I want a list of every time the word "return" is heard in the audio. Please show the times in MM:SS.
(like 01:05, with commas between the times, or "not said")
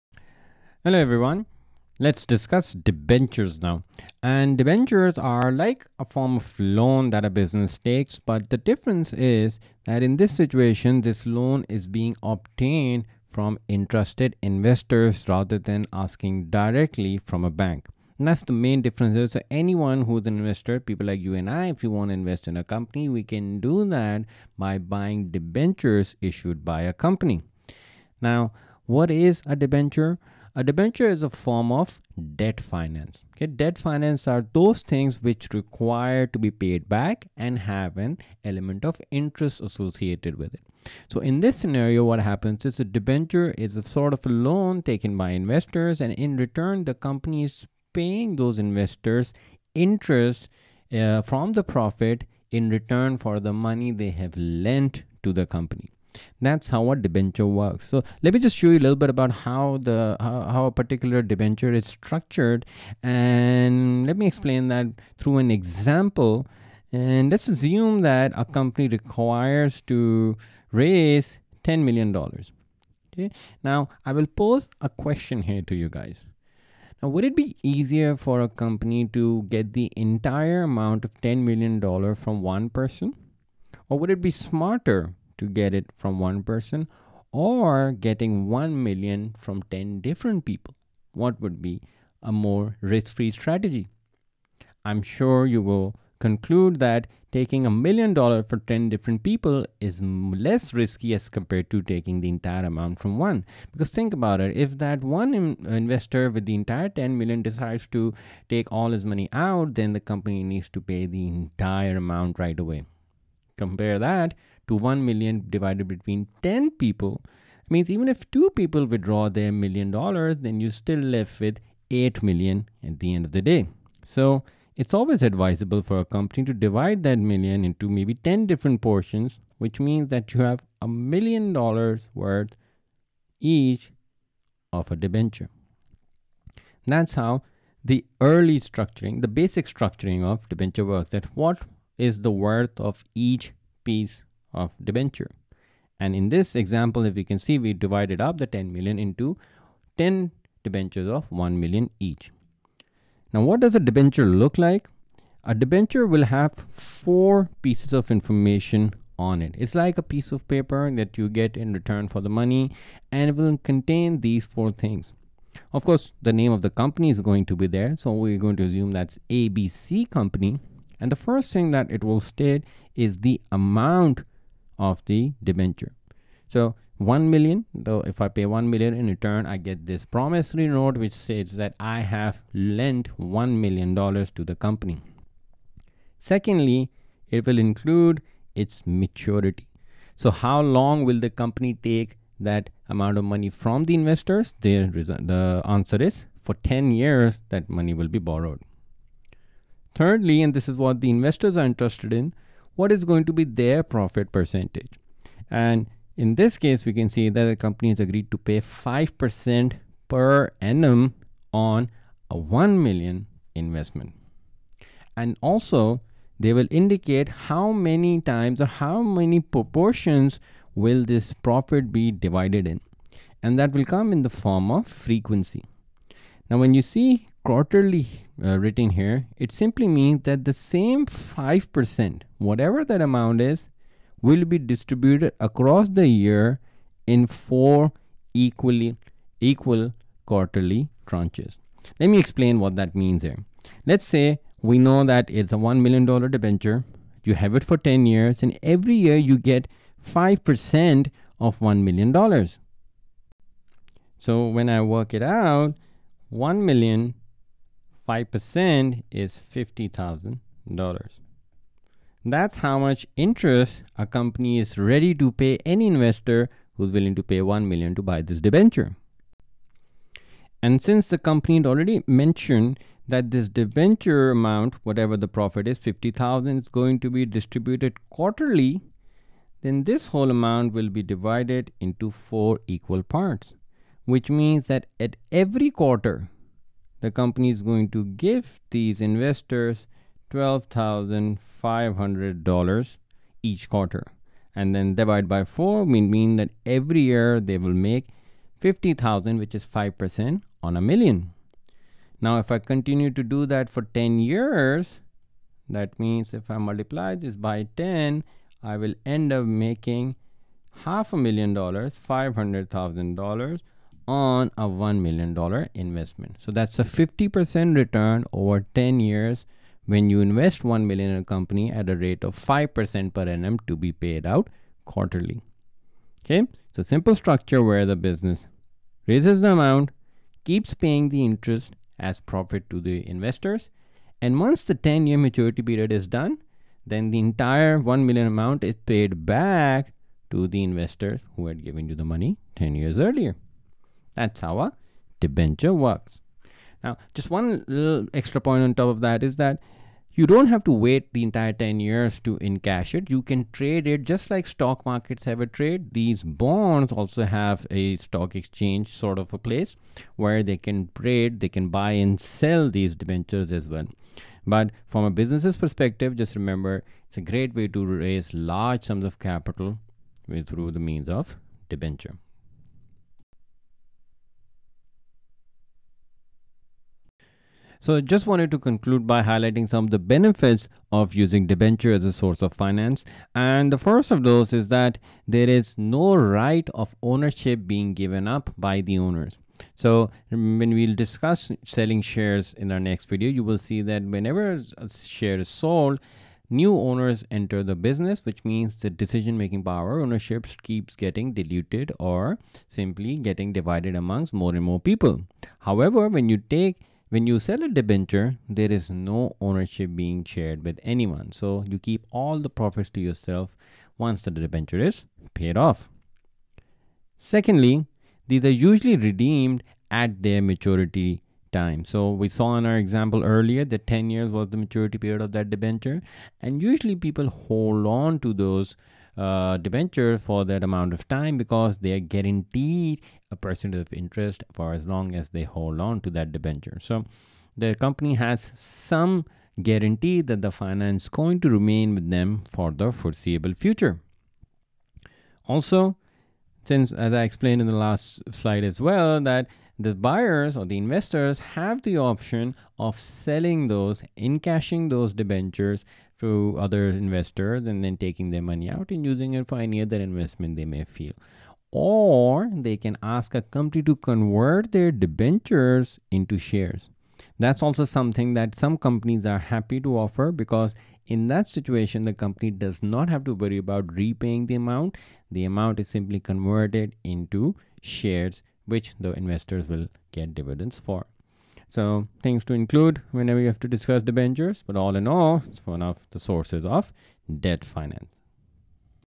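00:46, 00:52, 02:41, 02:59, 05:17.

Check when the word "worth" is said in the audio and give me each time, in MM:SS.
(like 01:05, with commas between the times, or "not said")
02:12, 02:22.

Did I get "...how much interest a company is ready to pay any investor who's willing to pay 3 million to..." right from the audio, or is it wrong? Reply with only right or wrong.
wrong.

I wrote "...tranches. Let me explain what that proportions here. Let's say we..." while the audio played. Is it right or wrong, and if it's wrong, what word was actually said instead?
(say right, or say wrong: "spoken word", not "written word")
wrong: "means", not "proportions".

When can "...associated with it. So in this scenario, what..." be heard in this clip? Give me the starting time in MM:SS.
00:39.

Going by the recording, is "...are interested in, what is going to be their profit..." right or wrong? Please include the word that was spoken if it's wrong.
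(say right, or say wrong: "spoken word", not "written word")
right.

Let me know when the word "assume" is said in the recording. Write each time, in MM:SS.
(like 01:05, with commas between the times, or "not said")
01:07, 02:48.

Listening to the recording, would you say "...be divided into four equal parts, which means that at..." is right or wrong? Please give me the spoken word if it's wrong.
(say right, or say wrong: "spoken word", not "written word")
right.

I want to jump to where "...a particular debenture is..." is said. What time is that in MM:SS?
01:00.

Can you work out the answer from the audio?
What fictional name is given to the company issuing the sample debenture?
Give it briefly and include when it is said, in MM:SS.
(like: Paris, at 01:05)
ABC company, at 02:49.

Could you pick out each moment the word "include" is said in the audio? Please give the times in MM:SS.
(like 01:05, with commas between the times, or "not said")
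03:07, 08:02.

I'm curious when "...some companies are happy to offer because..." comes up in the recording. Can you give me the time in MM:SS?
07:48.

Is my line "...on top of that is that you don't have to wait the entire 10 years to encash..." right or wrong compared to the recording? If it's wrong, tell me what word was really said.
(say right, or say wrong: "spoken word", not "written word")
right.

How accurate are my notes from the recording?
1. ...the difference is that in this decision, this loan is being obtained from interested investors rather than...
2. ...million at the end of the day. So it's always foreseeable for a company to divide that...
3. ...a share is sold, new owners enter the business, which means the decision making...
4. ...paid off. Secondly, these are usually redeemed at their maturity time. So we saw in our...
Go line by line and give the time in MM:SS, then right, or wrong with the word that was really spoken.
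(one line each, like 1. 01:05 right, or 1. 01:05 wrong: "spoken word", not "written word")
1. 00:08 wrong: "situation", not "decision"
2. 02:02 wrong: "advisable", not "foreseeable"
3. 06:34 right
4. 06:55 right.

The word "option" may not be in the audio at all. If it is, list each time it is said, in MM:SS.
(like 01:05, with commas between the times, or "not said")
07:31.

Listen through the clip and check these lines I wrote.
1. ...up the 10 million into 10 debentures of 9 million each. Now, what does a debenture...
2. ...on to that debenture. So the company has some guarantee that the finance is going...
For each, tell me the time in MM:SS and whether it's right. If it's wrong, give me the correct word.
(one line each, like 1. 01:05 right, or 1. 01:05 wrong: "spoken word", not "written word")
1. 02:28 wrong: "1", not "9"
2. 07:15 right.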